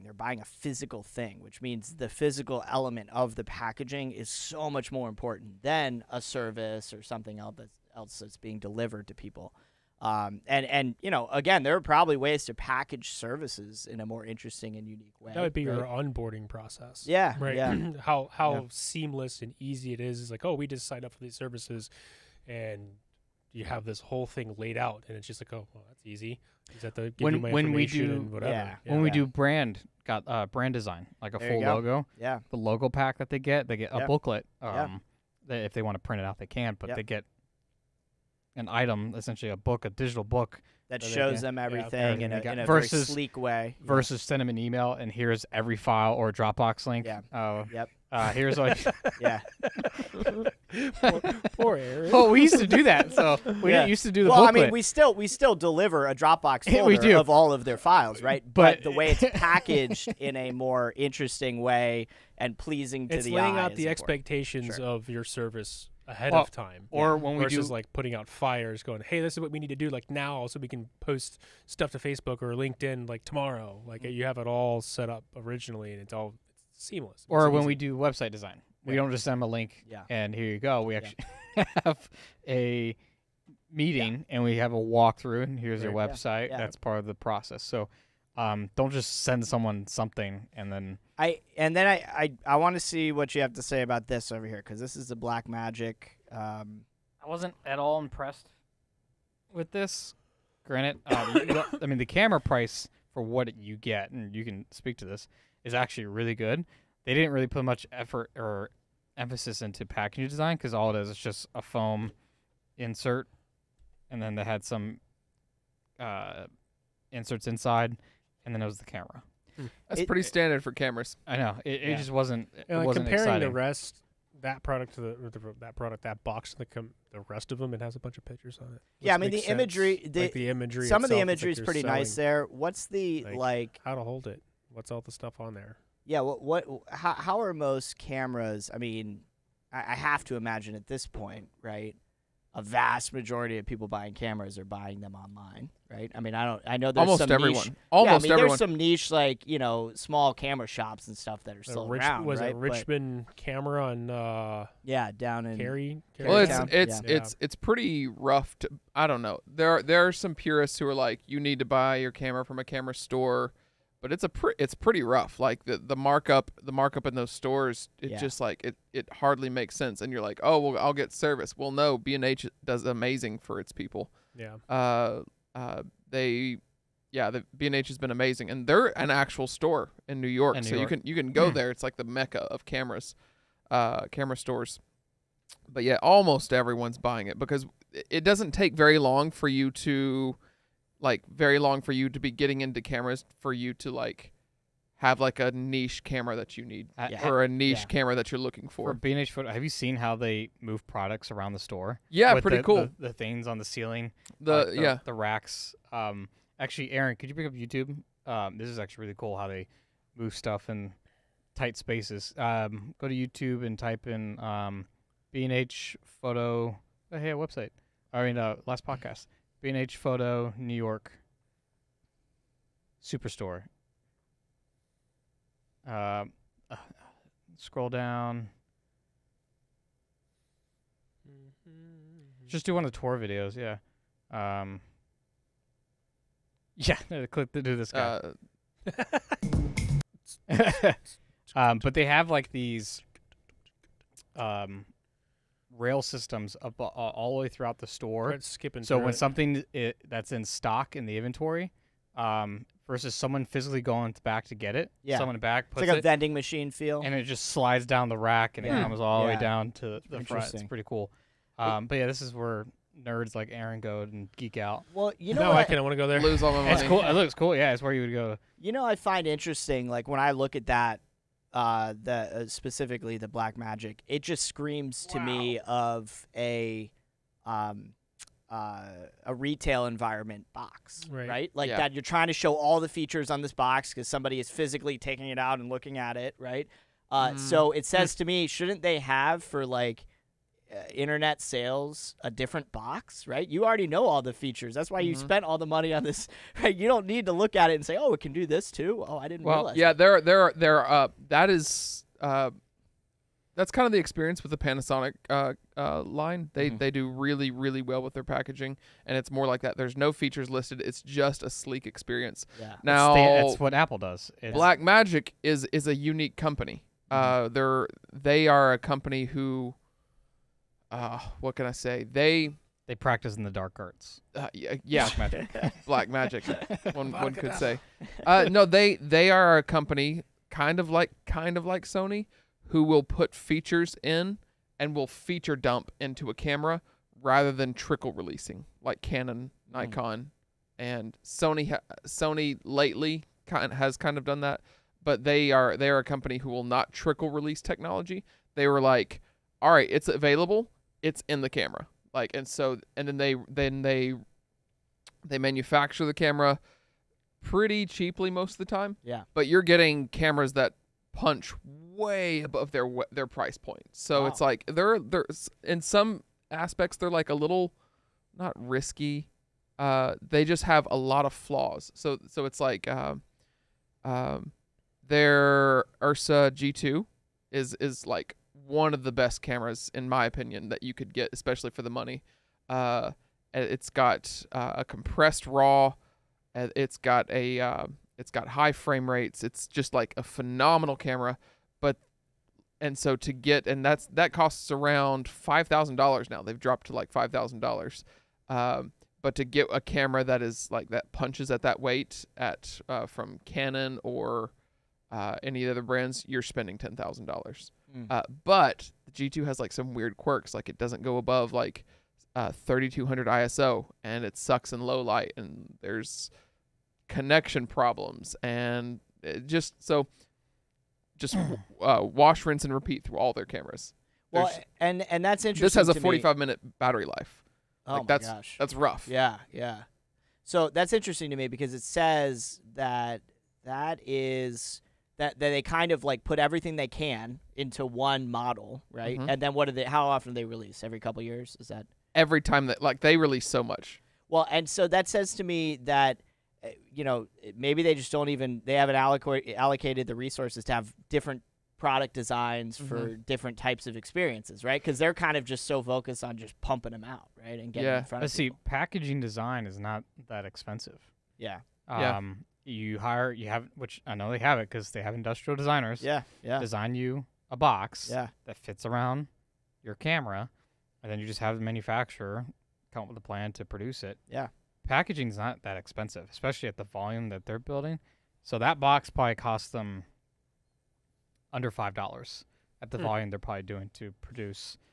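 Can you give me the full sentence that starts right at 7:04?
Well, There's, and and that's interesting.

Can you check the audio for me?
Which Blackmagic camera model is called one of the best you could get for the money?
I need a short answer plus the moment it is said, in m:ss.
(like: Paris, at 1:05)
Ursa G2, at 6:16.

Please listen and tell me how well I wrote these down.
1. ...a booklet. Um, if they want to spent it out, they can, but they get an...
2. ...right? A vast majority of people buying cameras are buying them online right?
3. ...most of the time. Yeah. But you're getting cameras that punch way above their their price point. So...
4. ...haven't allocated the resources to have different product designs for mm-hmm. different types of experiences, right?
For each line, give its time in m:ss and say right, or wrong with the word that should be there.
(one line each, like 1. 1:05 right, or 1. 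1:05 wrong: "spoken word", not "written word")
1. 0:33 wrong: "print", not "spent"
2. 2:21 right
3. 5:58 right
4. 7:28 right.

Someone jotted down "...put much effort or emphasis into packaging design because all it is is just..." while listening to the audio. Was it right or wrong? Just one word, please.
right.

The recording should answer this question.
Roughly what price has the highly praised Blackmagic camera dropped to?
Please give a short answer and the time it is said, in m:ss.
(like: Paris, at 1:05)
$5,000, at 6:35.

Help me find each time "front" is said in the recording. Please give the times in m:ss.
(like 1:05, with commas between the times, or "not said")
4:20, 7:38.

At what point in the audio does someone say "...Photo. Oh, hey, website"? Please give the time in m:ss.
3:36.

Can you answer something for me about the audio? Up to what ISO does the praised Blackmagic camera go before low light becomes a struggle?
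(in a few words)
3200.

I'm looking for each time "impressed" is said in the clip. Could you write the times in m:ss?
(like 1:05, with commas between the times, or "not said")
1:37.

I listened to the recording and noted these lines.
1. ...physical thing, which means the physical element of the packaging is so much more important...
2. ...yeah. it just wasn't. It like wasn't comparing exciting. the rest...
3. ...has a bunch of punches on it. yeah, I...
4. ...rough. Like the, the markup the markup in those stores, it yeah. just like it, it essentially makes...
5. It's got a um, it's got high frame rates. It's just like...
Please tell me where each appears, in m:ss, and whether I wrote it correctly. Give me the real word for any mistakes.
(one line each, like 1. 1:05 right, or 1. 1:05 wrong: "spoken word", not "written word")
1. 0:00 right
2. 2:01 right
3. 2:07 wrong: "pictures", not "punches"
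4. 2:45 wrong: "hardly", not "essentially"
5. 6:26 right.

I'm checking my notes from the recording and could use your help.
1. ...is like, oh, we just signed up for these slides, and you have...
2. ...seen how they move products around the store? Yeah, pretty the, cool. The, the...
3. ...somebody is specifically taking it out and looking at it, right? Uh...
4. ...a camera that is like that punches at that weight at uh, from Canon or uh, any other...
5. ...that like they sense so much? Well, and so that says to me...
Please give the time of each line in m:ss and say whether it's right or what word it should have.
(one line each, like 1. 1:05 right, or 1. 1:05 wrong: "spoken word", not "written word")
1. 0:20 wrong: "services", not "slides"
2. 3:19 right
3. 4:44 wrong: "physically", not "specifically"
4. 6:39 right
5. 7:22 wrong: "release", not "sense".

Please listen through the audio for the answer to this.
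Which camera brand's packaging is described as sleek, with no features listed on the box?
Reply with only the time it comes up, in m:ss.
5:04.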